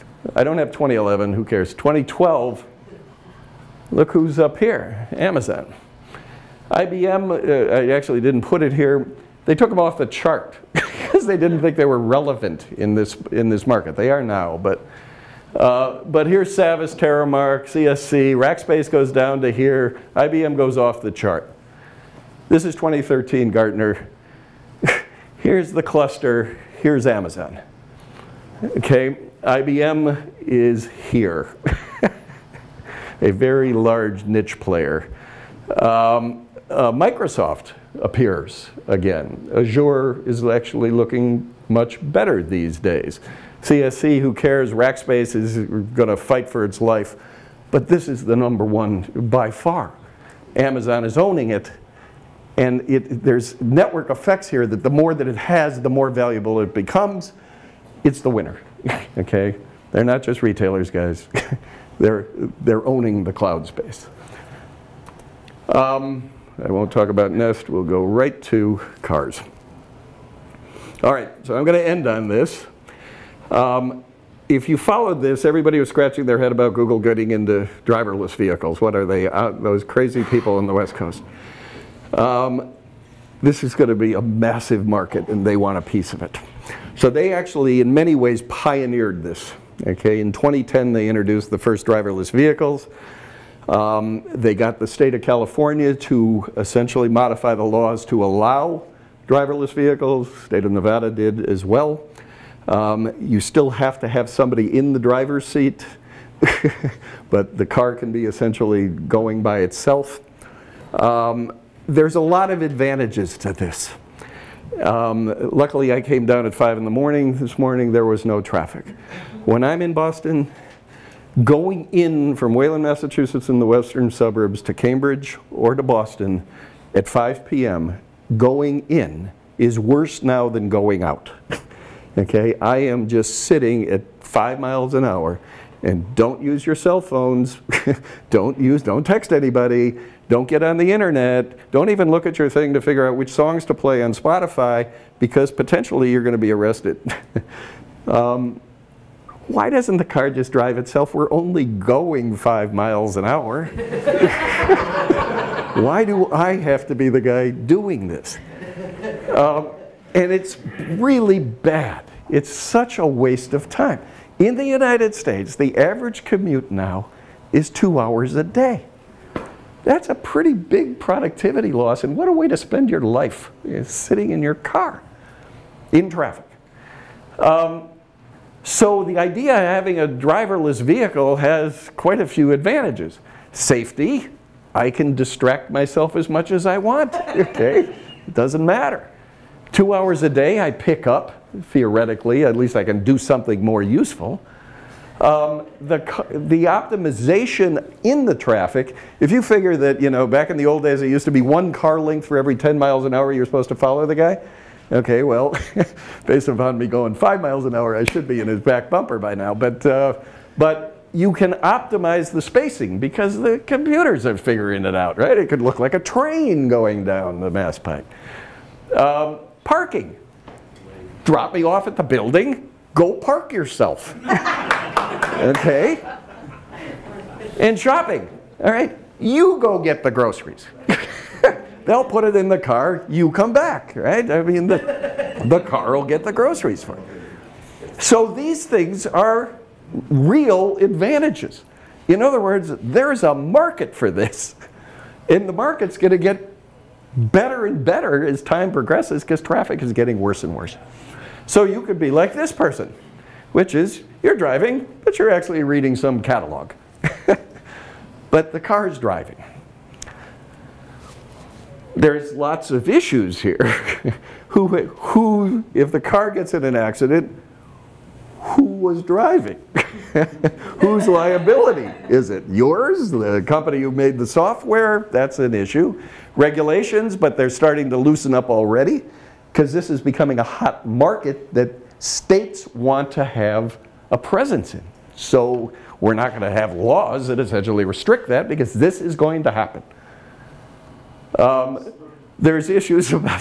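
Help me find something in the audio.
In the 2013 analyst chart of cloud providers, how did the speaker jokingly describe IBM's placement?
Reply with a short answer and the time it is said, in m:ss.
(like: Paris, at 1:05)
A very large niche player, at 0:33.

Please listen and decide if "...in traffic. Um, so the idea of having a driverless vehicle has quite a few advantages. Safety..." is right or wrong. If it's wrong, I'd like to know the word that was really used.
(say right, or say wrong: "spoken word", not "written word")
right.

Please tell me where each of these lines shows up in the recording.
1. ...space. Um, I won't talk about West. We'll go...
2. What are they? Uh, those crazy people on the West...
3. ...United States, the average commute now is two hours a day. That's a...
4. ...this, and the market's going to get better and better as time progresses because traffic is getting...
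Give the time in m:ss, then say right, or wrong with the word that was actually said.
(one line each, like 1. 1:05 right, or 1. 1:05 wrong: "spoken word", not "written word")
1. 1:03 wrong: "Nest", not "West"
2. 1:18 right
3. 2:44 right
4. 4:04 right.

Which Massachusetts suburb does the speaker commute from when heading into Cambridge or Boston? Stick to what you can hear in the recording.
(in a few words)
Wayland.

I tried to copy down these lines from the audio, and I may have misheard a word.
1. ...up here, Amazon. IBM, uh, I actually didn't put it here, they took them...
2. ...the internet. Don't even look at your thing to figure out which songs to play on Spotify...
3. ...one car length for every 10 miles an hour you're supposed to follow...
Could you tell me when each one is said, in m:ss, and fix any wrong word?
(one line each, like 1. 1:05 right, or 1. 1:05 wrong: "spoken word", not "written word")
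1. 0:04 right
2. 2:20 right
3. 3:21 right.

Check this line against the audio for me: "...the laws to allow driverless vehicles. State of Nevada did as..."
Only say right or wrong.
right.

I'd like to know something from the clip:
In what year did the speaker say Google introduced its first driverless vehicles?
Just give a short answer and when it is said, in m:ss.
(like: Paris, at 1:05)
2010, at 1:30.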